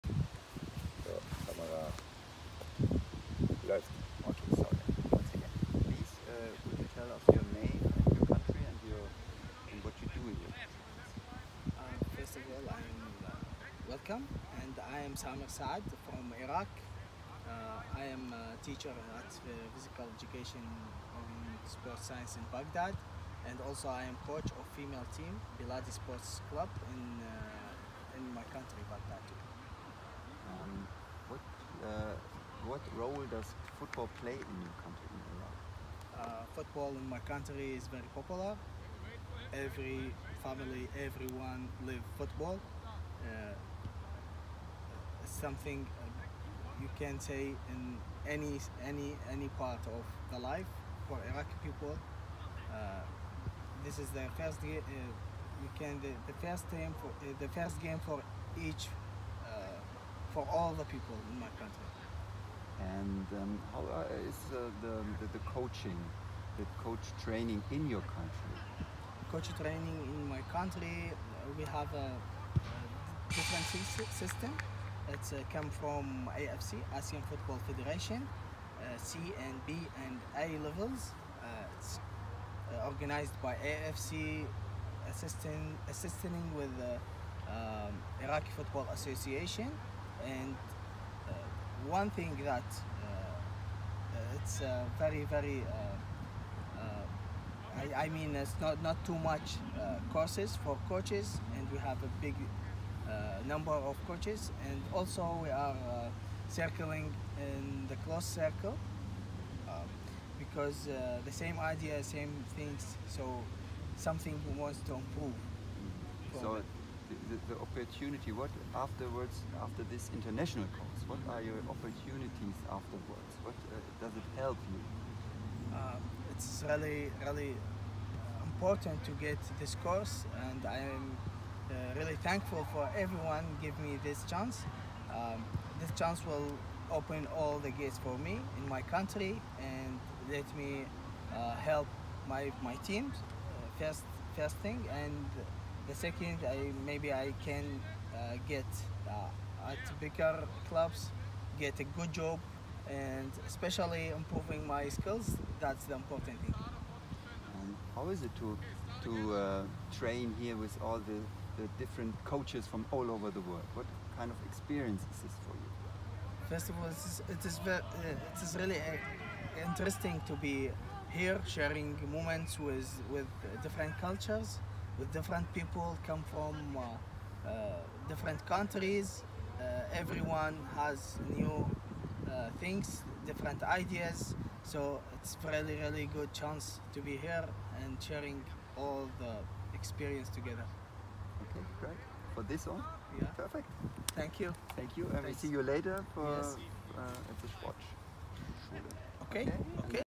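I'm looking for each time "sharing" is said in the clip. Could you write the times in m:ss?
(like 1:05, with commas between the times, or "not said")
2:51, 3:08.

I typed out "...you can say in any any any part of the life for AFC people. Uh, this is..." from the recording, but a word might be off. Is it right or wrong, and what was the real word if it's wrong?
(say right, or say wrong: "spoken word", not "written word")
wrong: "Iraqi", not "AFC".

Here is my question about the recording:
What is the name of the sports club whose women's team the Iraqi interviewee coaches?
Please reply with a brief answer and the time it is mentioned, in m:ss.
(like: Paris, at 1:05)
Biladi Sports Club, at 0:25.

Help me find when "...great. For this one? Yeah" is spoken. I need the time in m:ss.
3:11.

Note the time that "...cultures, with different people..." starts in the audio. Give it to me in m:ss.
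2:53.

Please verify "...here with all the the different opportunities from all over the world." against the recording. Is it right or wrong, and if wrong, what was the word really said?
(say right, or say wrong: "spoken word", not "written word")
wrong: "coaches", not "opportunities".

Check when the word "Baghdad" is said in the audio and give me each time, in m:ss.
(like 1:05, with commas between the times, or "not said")
0:22, 0:28.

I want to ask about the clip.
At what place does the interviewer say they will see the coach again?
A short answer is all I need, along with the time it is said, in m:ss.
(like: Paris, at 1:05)
Sportschule, at 3:17.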